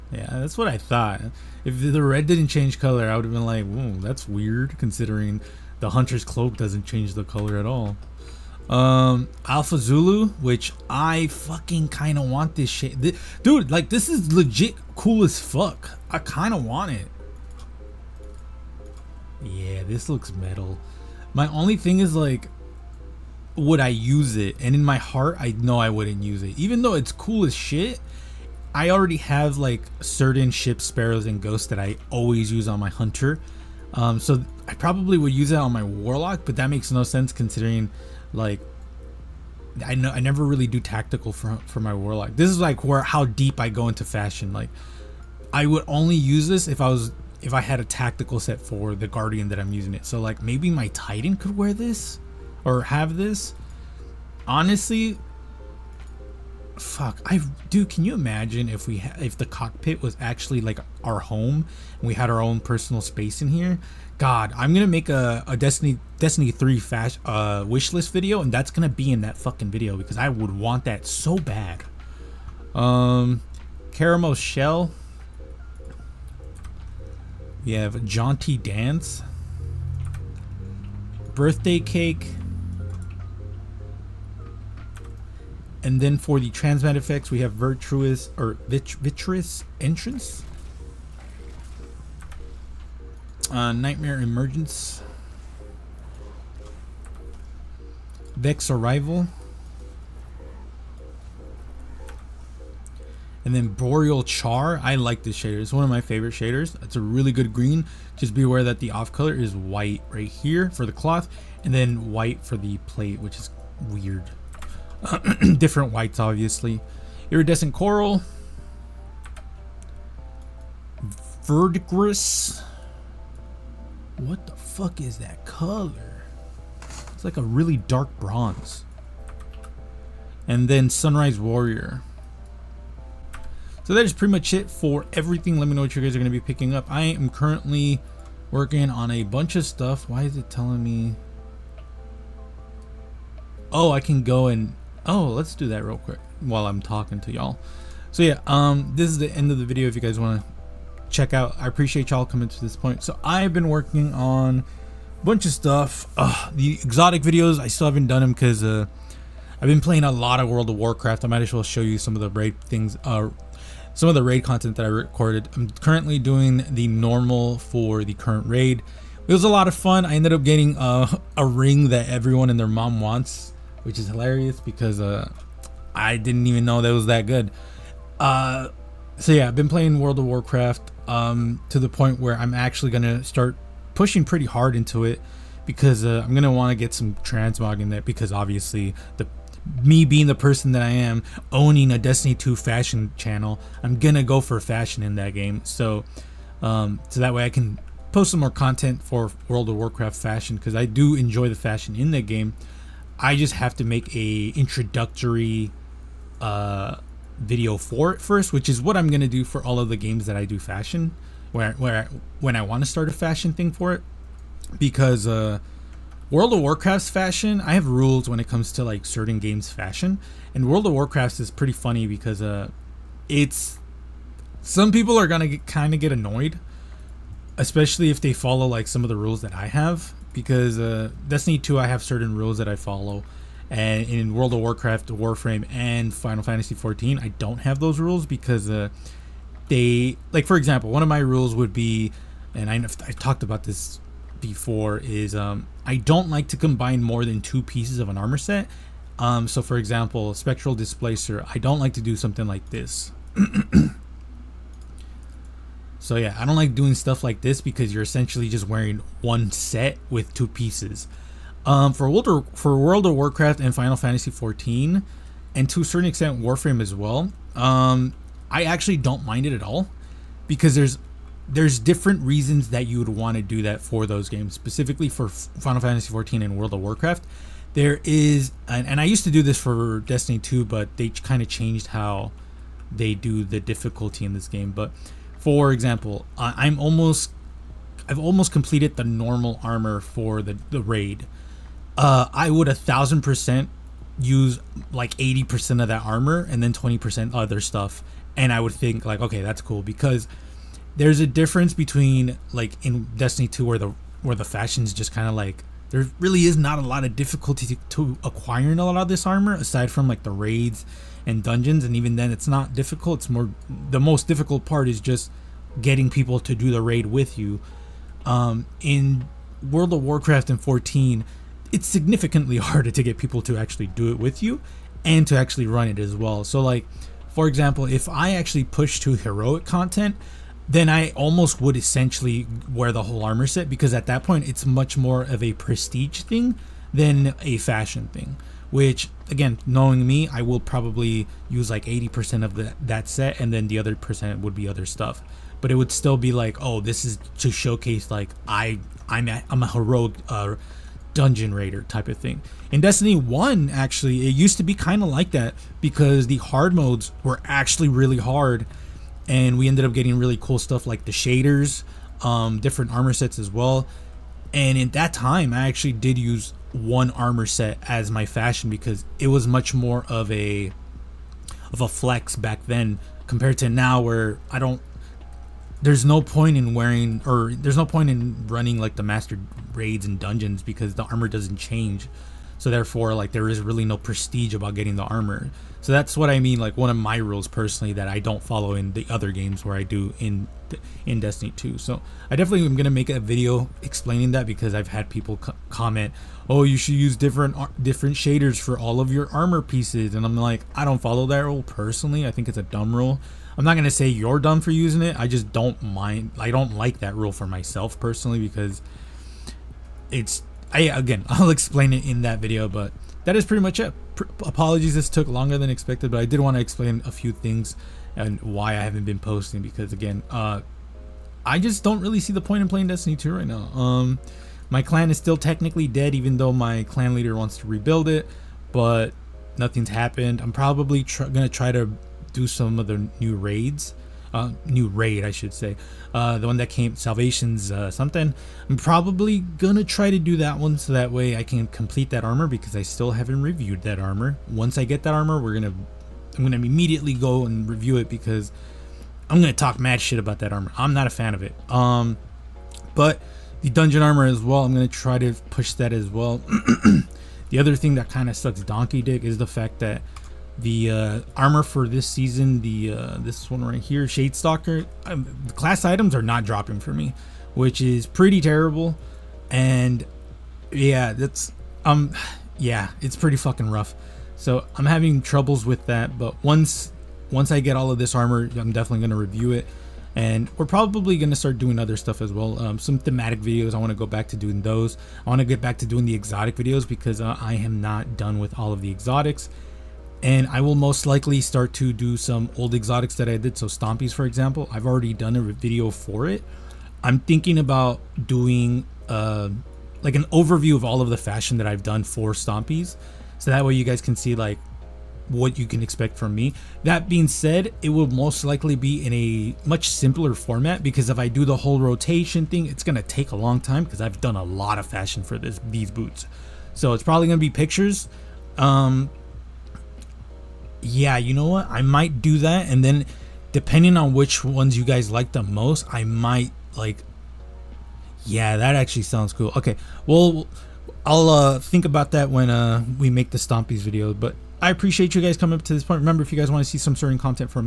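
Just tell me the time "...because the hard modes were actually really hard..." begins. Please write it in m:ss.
5:55.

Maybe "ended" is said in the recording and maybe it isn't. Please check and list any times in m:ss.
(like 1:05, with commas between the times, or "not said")
2:50, 5:59.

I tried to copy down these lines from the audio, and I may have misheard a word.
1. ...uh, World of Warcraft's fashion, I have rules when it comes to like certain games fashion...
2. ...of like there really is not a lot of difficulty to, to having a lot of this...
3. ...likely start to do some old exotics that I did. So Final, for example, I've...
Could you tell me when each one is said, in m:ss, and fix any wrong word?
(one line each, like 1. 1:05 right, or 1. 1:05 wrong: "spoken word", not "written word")
1. 3:35 right
2. 5:05 wrong: "acquiring", not "having"
3. 8:11 wrong: "Stompies", not "Final".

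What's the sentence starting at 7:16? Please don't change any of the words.
Uh, the one that came, Salvation's uh, something.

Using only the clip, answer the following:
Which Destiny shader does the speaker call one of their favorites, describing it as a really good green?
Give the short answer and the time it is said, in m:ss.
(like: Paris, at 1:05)
Boreal Char, at 1:43.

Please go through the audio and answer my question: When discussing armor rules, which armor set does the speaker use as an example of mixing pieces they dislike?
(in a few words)
Spectral Displacer.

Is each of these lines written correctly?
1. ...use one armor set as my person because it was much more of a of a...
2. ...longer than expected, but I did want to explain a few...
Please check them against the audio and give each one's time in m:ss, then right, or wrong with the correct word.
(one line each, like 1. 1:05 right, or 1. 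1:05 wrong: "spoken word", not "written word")
1. 6:06 wrong: "fashion", not "person"
2. 6:55 right.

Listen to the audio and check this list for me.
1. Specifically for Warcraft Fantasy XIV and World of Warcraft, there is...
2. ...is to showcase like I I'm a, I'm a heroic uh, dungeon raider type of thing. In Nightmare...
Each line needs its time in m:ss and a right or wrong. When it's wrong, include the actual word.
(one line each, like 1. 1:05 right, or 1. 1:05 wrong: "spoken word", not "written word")
1. 4:34 wrong: "Final", not "Warcraft"
2. 5:47 wrong: "Destiny", not "Nightmare".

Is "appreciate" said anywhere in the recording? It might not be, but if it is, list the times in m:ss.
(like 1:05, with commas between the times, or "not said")
2:31, 8:54.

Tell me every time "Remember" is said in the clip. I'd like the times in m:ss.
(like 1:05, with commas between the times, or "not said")
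8:56.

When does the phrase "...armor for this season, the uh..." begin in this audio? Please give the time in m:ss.
7:41.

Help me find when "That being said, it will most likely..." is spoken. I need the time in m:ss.
8:26.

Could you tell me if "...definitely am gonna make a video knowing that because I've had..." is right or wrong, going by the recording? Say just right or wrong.
wrong.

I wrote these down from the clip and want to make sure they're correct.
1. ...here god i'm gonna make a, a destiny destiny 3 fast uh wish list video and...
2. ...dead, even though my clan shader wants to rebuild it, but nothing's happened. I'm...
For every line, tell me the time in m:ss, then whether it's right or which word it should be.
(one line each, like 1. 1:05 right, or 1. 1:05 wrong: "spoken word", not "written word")
1. 1:03 right
2. 7:05 wrong: "leader", not "shader".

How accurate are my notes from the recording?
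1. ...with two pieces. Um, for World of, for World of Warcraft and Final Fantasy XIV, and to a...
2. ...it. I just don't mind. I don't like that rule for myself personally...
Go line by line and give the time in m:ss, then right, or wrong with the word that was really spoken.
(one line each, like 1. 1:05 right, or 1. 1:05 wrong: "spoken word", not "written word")
1. 4:20 right
2. 6:45 right.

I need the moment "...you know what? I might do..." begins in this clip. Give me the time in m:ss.
8:41.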